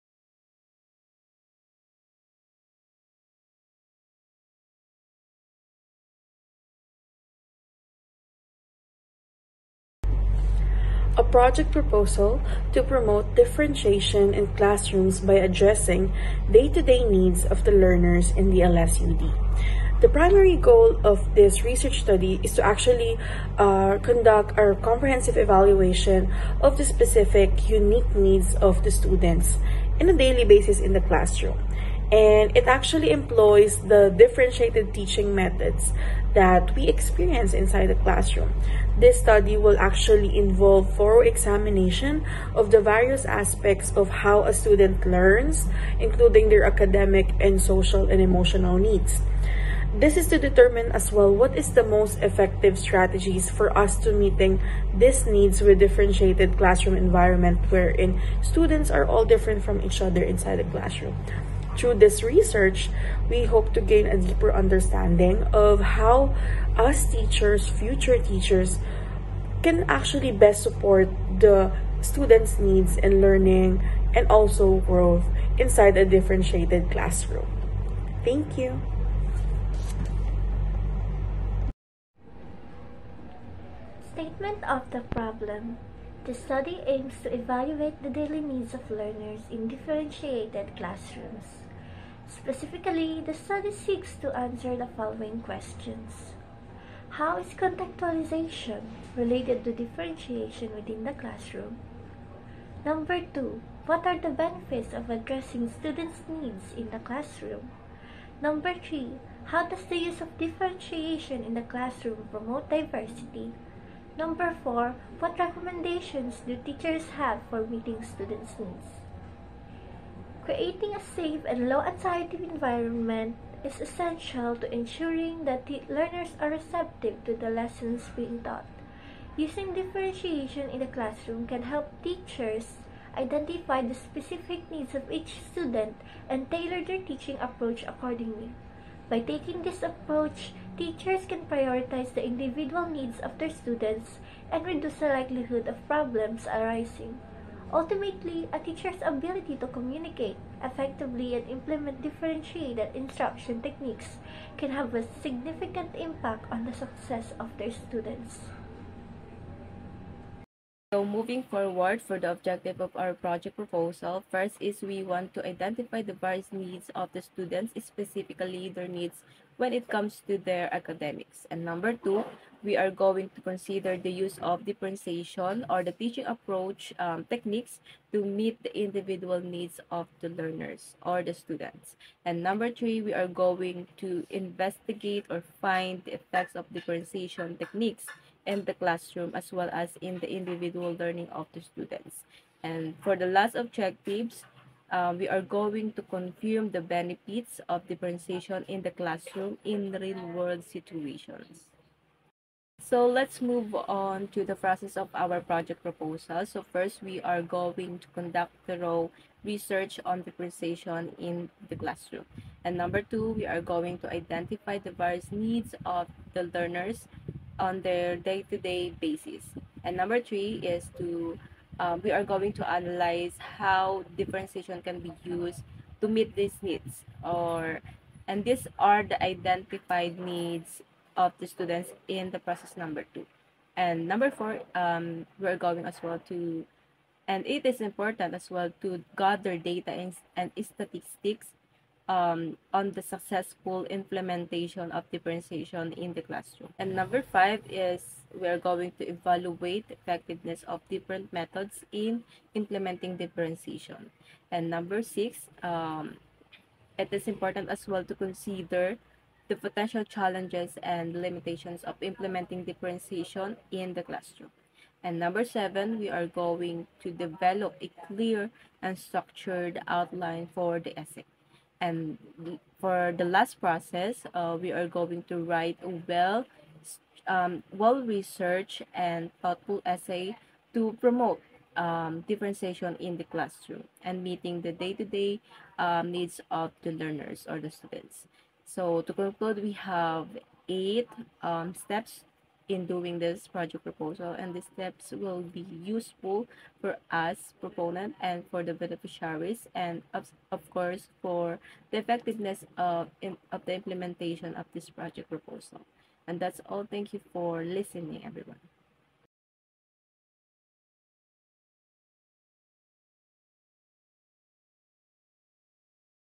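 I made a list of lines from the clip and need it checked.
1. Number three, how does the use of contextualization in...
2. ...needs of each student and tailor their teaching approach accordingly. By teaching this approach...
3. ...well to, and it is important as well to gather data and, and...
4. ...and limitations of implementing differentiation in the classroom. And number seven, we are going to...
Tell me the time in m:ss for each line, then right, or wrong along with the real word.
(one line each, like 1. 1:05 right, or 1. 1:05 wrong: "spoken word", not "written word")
1. 1:48 wrong: "differentiation", not "contextualization"
2. 2:14 wrong: "taking", not "teaching"
3. 3:56 right
4. 4:20 right.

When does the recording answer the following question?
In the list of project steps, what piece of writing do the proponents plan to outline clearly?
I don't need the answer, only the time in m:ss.
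4:30.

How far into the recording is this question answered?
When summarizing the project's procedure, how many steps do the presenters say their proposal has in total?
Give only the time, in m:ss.
4:50.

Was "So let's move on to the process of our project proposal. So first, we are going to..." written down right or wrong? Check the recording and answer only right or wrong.
right.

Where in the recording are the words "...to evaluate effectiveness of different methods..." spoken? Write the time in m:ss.
4:08.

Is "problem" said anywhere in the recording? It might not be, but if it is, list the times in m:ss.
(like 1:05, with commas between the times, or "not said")
1:25, 2:25.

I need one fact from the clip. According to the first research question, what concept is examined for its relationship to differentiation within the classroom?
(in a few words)
Contextualization.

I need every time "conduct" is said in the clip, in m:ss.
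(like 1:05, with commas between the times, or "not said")
0:24, 3:28.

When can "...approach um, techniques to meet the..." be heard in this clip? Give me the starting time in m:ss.
2:56.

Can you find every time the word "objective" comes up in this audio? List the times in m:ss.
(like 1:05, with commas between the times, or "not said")
2:42, 3:13.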